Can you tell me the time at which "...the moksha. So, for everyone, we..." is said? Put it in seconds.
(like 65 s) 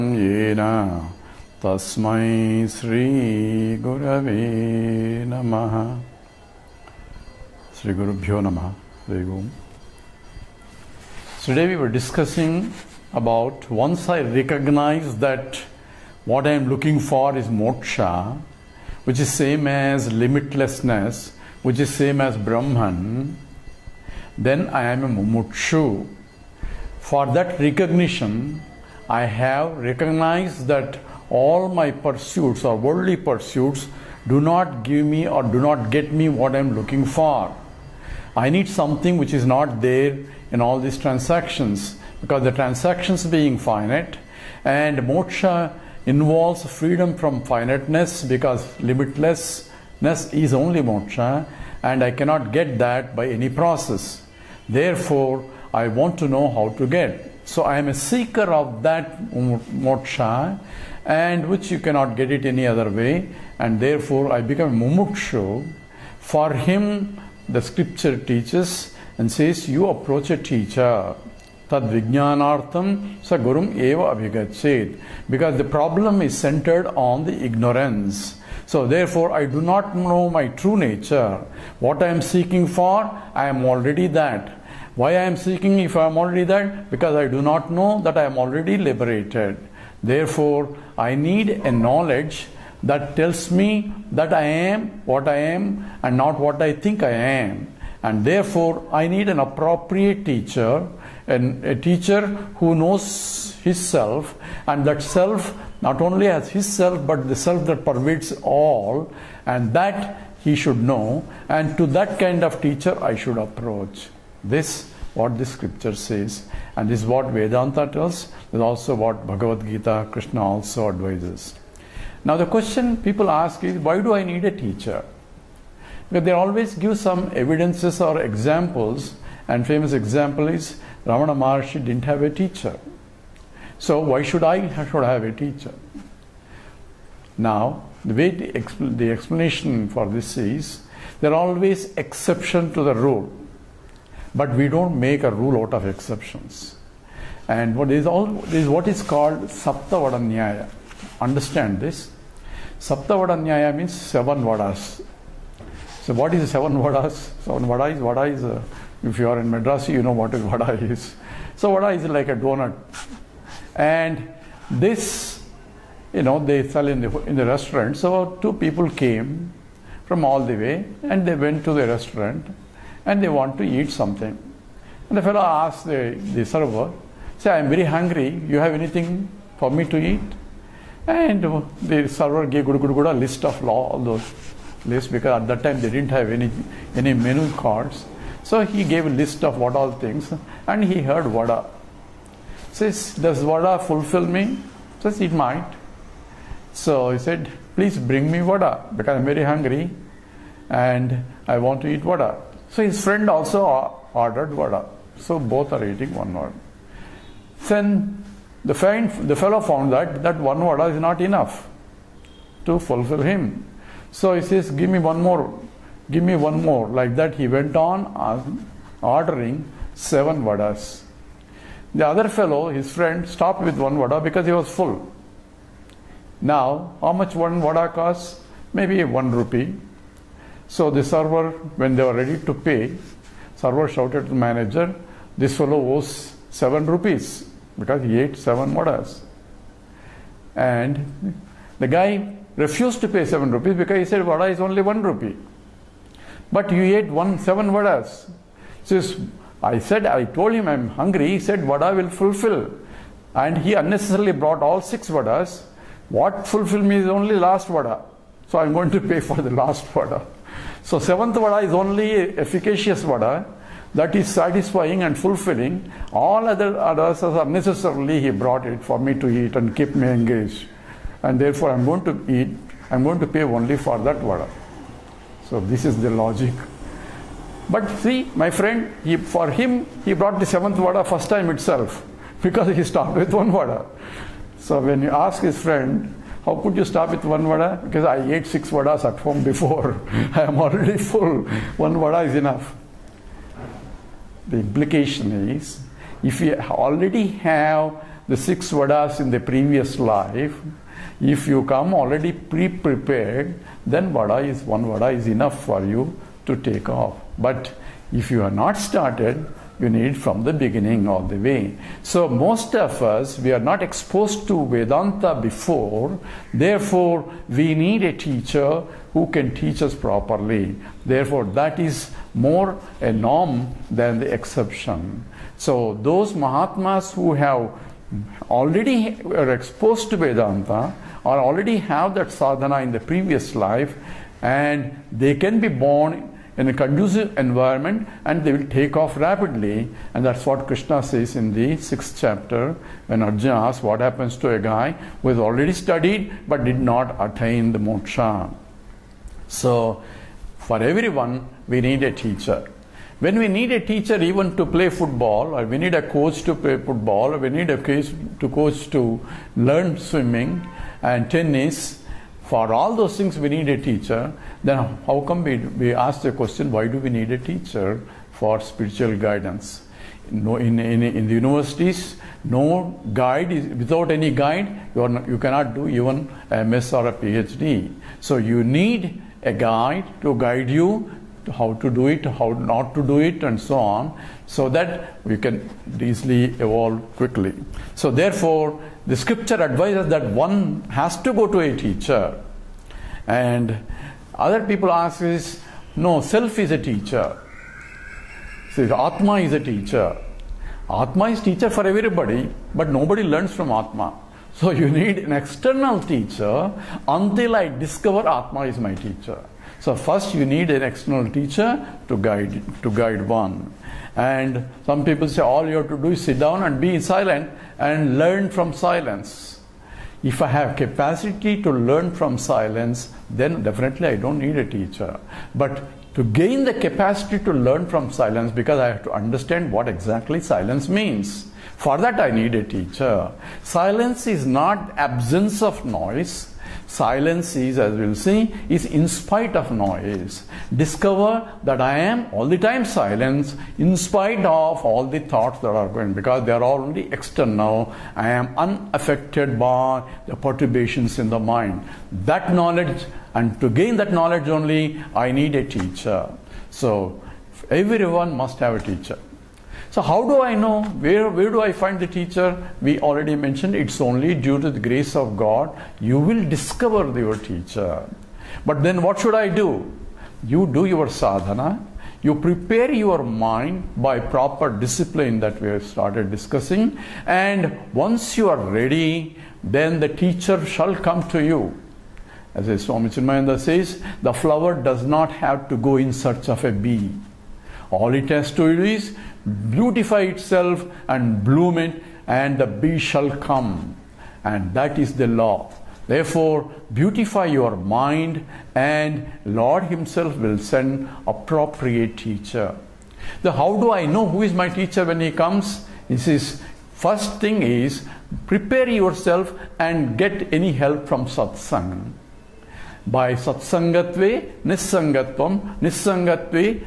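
347 s.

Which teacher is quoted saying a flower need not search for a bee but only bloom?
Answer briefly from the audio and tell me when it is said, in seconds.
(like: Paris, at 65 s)
Swami Chinmayananda, at 482 s.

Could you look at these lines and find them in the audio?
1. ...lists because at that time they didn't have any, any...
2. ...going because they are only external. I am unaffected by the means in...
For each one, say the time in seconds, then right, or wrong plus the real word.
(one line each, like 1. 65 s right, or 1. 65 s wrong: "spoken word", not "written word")
1. 184 s right
2. 445 s wrong: "perturbations", not "means".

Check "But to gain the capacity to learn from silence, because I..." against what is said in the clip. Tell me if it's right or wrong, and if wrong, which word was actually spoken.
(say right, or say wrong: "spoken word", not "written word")
right.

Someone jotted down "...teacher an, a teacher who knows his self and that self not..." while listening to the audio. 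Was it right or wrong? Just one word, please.
right.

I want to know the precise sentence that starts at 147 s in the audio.
And what is all is what is called Saptavadaniya.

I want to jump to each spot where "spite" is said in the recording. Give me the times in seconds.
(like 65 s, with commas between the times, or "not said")
439 s, 443 s.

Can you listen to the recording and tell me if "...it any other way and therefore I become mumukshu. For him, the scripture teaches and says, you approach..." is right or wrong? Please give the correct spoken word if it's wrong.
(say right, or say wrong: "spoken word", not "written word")
right.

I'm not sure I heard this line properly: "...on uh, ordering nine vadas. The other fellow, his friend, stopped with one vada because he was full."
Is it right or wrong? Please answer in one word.
wrong.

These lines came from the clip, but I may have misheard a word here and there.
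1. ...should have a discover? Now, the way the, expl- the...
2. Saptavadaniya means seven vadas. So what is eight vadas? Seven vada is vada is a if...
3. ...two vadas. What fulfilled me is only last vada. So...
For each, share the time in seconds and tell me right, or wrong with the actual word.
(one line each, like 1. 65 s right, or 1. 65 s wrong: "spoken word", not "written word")
1. 134 s wrong: "teacher", not "discover"
2. 152 s wrong: "seven", not "eight"
3. 254 s wrong: "six", not "two".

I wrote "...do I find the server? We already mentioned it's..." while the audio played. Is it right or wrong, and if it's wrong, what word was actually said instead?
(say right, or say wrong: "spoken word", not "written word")
wrong: "teacher", not "server".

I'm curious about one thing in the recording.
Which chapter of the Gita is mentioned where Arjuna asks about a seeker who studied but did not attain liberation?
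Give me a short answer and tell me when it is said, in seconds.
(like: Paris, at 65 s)
sixth chapter, at 341 s.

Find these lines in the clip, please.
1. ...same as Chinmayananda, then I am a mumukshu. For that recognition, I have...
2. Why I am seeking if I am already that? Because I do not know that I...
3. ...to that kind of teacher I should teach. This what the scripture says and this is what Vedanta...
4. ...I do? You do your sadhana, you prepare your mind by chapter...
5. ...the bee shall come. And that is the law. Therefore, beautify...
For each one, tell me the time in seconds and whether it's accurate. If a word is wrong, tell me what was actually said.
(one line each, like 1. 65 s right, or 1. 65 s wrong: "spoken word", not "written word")
1. 21 s wrong: "Brahman", not "Chinmayananda"
2. 84 s right
3. 111 s wrong: "approach", not "teach"
4. 469 s wrong: "proper", not "chapter"
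5. 492 s right.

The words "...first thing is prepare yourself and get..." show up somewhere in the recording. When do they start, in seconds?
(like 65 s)
506 s.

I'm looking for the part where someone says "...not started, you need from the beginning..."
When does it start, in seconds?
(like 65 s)
308 s.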